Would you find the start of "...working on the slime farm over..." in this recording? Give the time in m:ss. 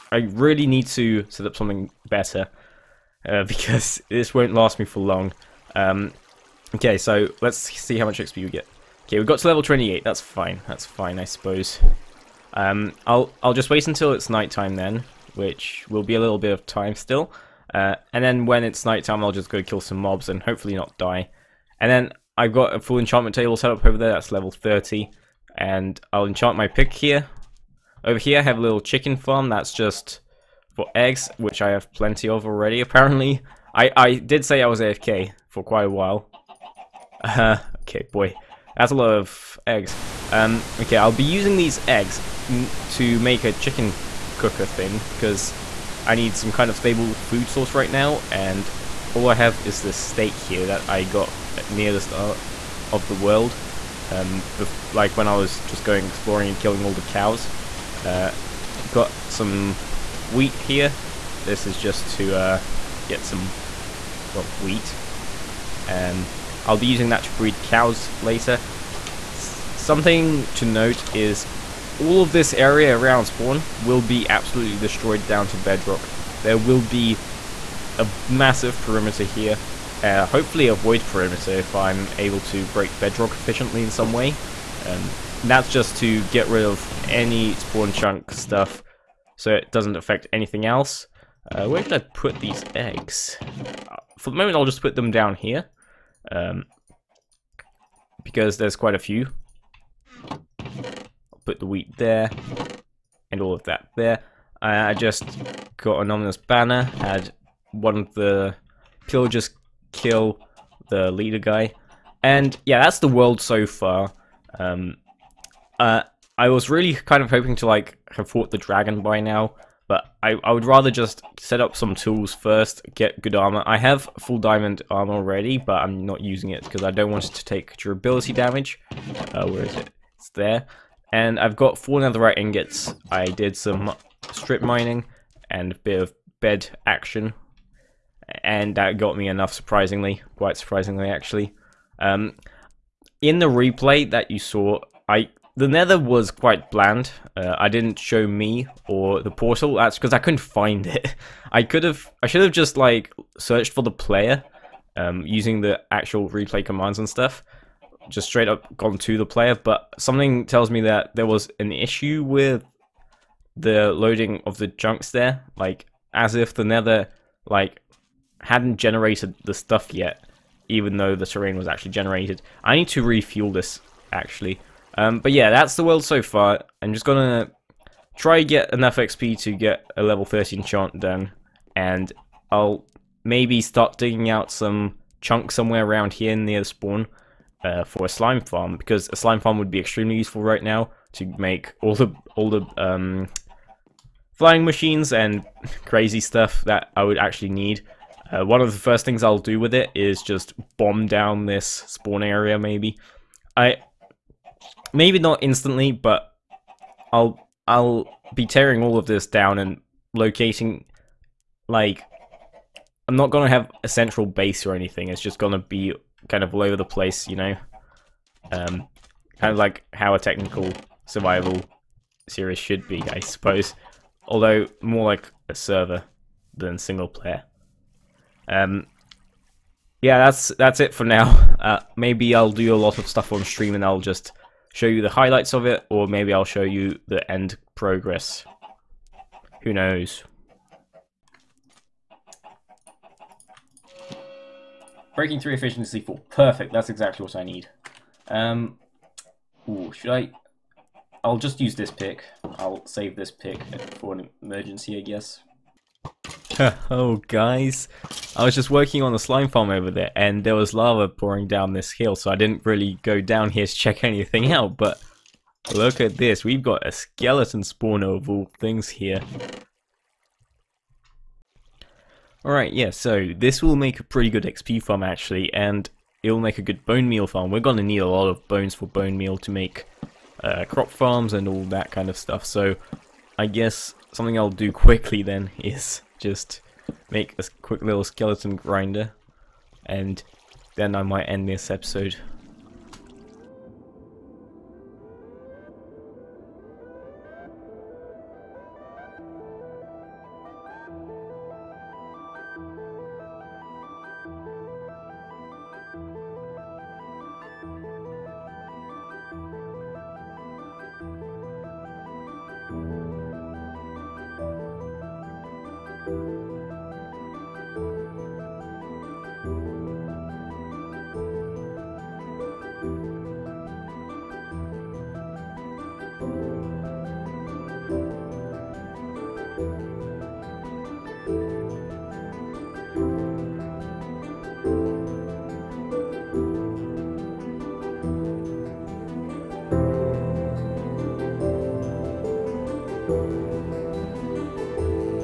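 4:18.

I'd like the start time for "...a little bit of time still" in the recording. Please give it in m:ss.
0:16.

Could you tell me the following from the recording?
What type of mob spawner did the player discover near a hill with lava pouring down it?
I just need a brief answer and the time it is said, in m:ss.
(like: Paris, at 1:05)
skeleton spawner, at 4:26.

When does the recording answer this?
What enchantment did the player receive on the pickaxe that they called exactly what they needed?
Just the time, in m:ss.
4:05.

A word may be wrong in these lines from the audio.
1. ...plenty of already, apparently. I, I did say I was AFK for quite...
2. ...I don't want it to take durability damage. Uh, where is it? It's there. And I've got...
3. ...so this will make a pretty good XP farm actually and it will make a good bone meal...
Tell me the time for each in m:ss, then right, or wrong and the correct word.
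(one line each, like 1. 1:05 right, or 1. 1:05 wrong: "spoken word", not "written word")
1. 0:31 right
2. 2:06 right
3. 4:32 right.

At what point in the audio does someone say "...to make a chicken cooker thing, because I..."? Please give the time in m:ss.
0:42.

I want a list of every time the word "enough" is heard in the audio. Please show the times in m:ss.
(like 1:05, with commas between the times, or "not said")
2:19, 2:58.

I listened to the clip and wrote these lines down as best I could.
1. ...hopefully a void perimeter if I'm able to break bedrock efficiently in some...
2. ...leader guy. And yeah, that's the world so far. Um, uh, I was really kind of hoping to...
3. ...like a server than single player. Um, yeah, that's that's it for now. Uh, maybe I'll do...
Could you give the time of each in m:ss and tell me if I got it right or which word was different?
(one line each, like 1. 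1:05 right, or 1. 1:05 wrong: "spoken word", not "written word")
1. 1:20 right
2. 1:51 right
3. 3:45 right.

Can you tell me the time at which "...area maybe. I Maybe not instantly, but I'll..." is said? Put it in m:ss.
3:22.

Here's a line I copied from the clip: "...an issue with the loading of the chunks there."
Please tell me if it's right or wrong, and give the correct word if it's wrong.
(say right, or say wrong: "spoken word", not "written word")
right.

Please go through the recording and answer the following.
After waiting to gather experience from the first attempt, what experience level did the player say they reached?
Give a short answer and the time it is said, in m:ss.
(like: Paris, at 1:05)
28, at 0:09.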